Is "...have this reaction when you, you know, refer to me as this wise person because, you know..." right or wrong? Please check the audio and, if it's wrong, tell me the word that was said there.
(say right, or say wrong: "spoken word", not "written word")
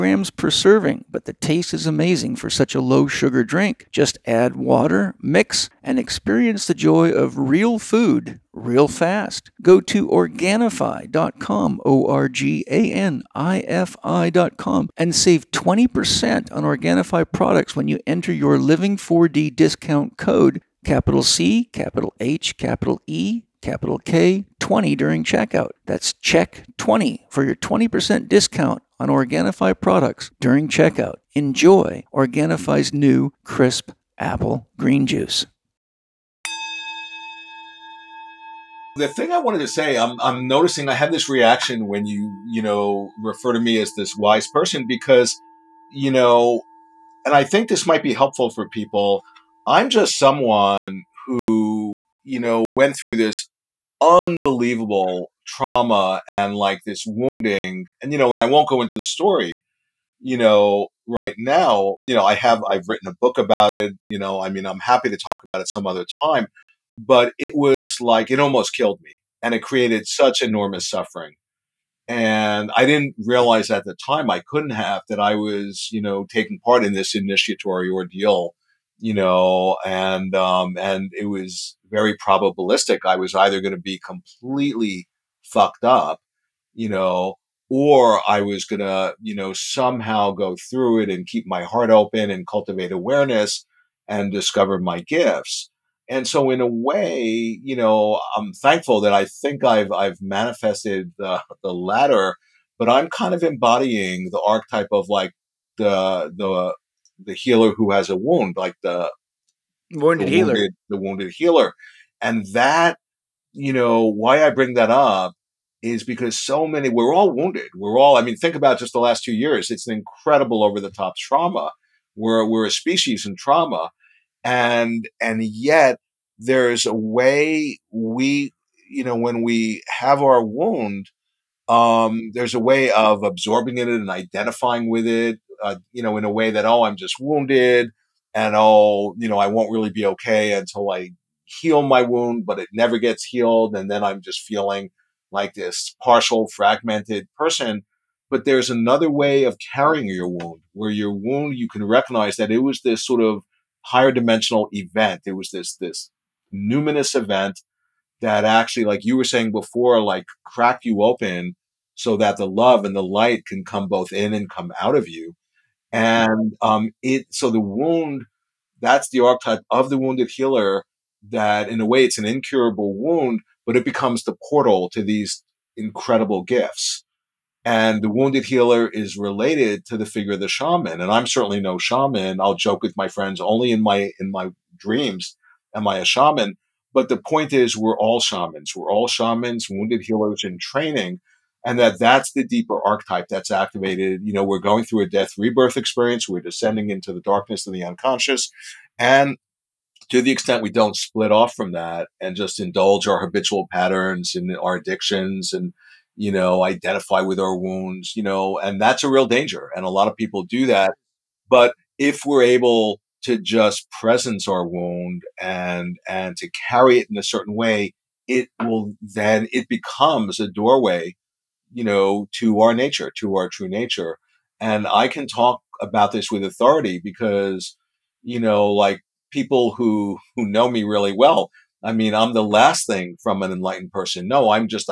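right.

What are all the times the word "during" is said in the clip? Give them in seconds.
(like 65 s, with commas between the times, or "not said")
24 s, 30 s.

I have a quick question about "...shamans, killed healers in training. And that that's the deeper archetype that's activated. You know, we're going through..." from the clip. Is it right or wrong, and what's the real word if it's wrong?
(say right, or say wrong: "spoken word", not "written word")
wrong: "wounded", not "killed".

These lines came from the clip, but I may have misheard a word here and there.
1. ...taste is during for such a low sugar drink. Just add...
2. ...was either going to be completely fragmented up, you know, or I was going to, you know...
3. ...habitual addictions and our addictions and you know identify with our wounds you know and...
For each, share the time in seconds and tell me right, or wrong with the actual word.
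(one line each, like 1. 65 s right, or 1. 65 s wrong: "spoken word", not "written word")
1. 1 s wrong: "amazing", not "during"
2. 83 s wrong: "fucked", not "fragmented"
3. 203 s wrong: "patterns", not "addictions".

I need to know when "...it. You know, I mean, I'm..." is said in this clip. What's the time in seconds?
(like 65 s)
63 s.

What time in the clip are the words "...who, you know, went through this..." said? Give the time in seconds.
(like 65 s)
51 s.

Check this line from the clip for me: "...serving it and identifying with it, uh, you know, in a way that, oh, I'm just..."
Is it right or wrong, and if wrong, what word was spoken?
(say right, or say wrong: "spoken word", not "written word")
wrong: "absorbing", not "serving".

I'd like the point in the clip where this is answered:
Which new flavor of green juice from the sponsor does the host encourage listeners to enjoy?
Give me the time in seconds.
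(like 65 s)
33 s.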